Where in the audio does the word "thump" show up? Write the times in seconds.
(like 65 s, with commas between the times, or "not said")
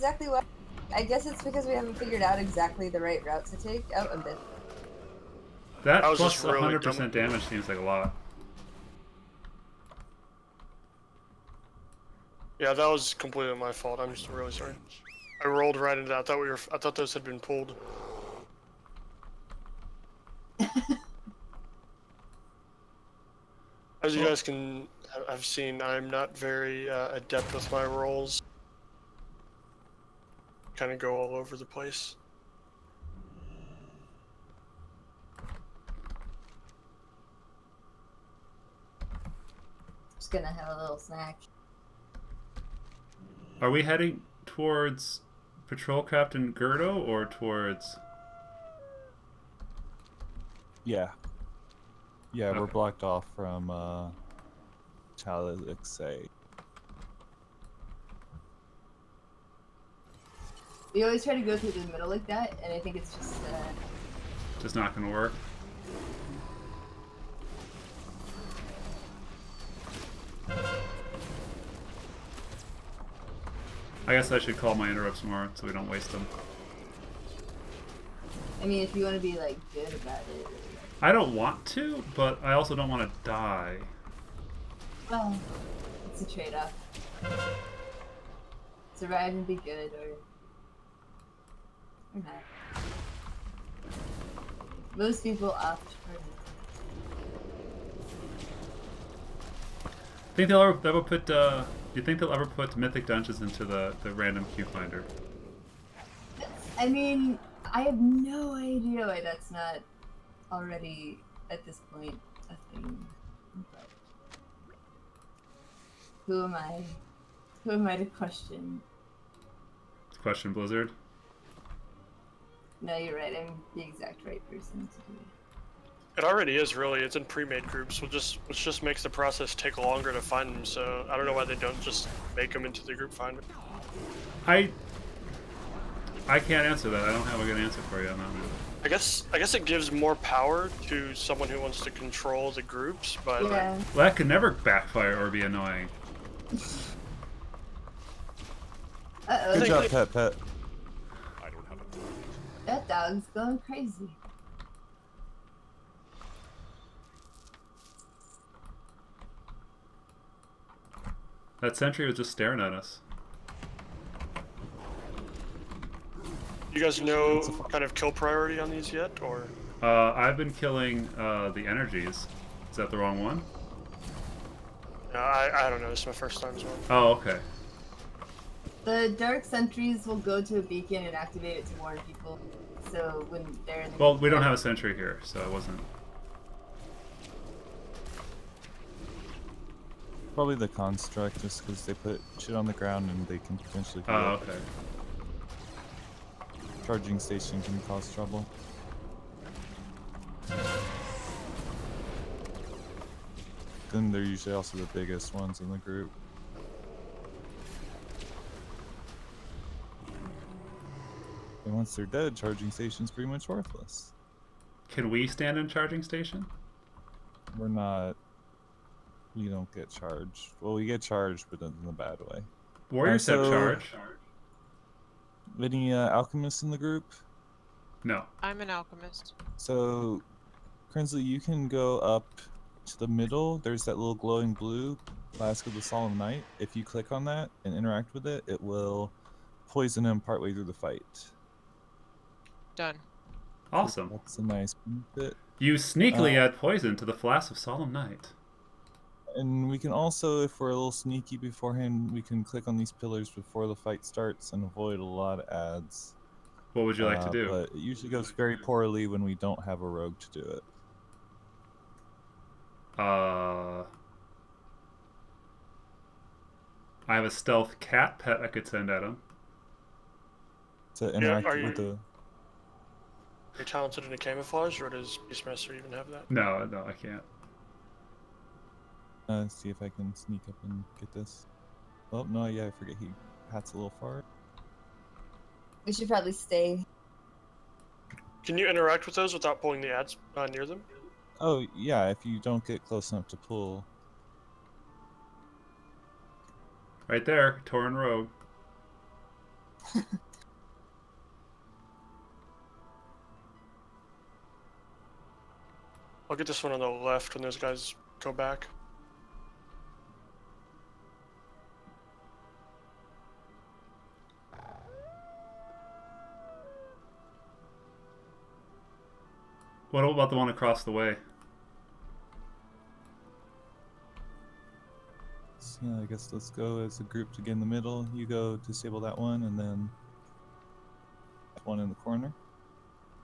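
not said.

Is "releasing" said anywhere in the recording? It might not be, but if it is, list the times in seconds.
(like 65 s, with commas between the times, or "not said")
not said.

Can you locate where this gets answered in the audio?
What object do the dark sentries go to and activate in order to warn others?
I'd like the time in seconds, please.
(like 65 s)
180 s.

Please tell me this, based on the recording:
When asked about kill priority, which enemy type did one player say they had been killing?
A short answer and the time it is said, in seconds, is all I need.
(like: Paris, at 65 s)
the energies, at 171 s.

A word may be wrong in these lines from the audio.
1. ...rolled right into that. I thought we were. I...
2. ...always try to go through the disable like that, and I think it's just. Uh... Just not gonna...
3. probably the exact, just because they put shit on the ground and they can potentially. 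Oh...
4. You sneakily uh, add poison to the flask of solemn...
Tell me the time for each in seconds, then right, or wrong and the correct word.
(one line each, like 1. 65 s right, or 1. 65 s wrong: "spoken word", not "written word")
1. 15 s right
2. 61 s wrong: "middle", not "disable"
3. 190 s wrong: "construct", not "exact"
4. 245 s right.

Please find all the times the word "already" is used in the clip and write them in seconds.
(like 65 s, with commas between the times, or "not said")
110 s, 126 s.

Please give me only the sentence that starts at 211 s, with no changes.
And once they're dead, charging station's pretty much worthless.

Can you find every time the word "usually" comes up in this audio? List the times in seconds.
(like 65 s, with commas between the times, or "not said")
204 s, 257 s.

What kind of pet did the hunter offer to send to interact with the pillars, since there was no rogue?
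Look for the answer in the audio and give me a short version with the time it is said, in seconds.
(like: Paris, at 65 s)
stealth cat, at 267 s.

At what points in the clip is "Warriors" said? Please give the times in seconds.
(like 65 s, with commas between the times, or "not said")
222 s.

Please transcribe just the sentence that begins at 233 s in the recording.
There's that little glowing blue flask of the solemn night.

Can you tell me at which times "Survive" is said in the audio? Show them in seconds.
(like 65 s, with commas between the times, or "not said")
88 s.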